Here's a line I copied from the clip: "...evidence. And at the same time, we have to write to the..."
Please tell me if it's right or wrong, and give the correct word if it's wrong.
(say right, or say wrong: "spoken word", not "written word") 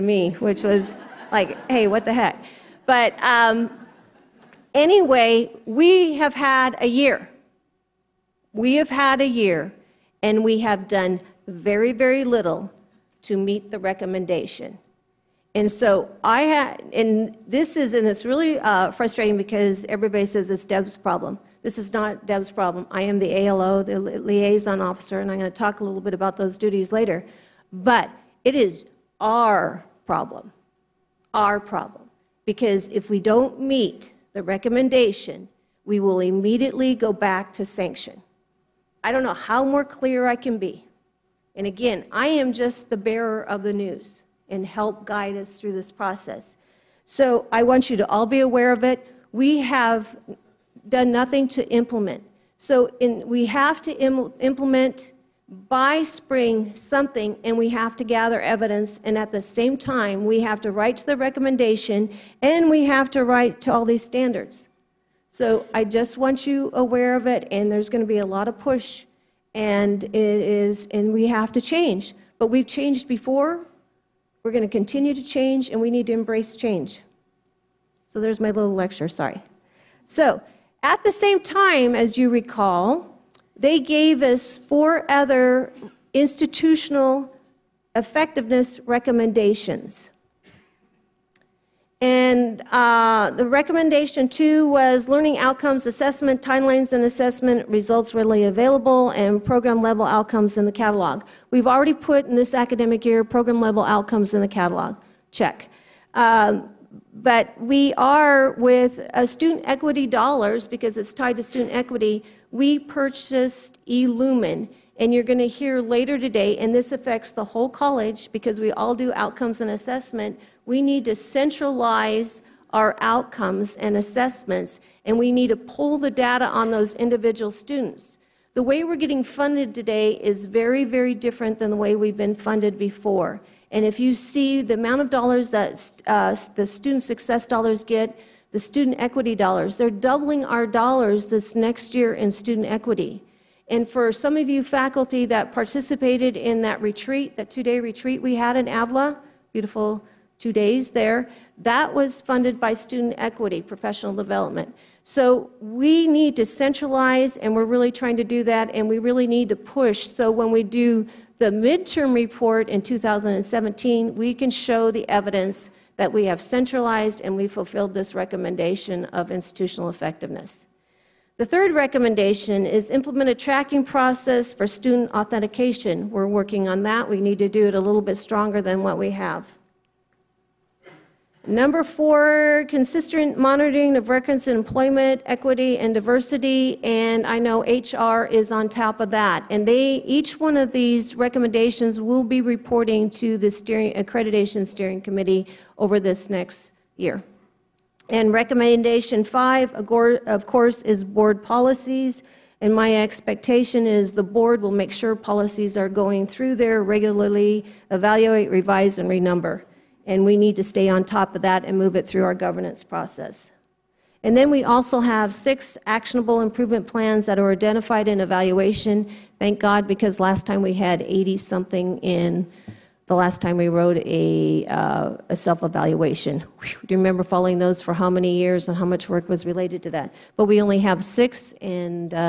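right.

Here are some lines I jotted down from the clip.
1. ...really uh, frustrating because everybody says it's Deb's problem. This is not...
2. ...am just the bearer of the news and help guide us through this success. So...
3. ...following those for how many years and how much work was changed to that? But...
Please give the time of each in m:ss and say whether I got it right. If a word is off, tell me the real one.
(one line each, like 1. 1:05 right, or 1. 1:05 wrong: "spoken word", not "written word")
1. 0:18 right
2. 0:42 wrong: "process", not "success"
3. 3:47 wrong: "related", not "changed".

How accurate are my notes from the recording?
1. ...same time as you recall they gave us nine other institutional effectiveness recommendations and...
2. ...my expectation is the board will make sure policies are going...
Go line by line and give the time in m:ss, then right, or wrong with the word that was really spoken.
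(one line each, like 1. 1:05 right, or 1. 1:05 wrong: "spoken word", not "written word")
1. 1:21 wrong: "four", not "nine"
2. 3:22 right.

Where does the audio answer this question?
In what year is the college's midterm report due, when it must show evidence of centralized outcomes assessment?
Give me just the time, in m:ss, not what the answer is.
2:42.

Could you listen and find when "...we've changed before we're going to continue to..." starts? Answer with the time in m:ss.
1:12.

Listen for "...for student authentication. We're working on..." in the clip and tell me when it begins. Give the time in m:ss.
2:54.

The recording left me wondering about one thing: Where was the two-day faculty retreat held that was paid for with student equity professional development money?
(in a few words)
Avila.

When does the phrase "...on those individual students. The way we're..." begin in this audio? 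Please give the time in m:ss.
2:06.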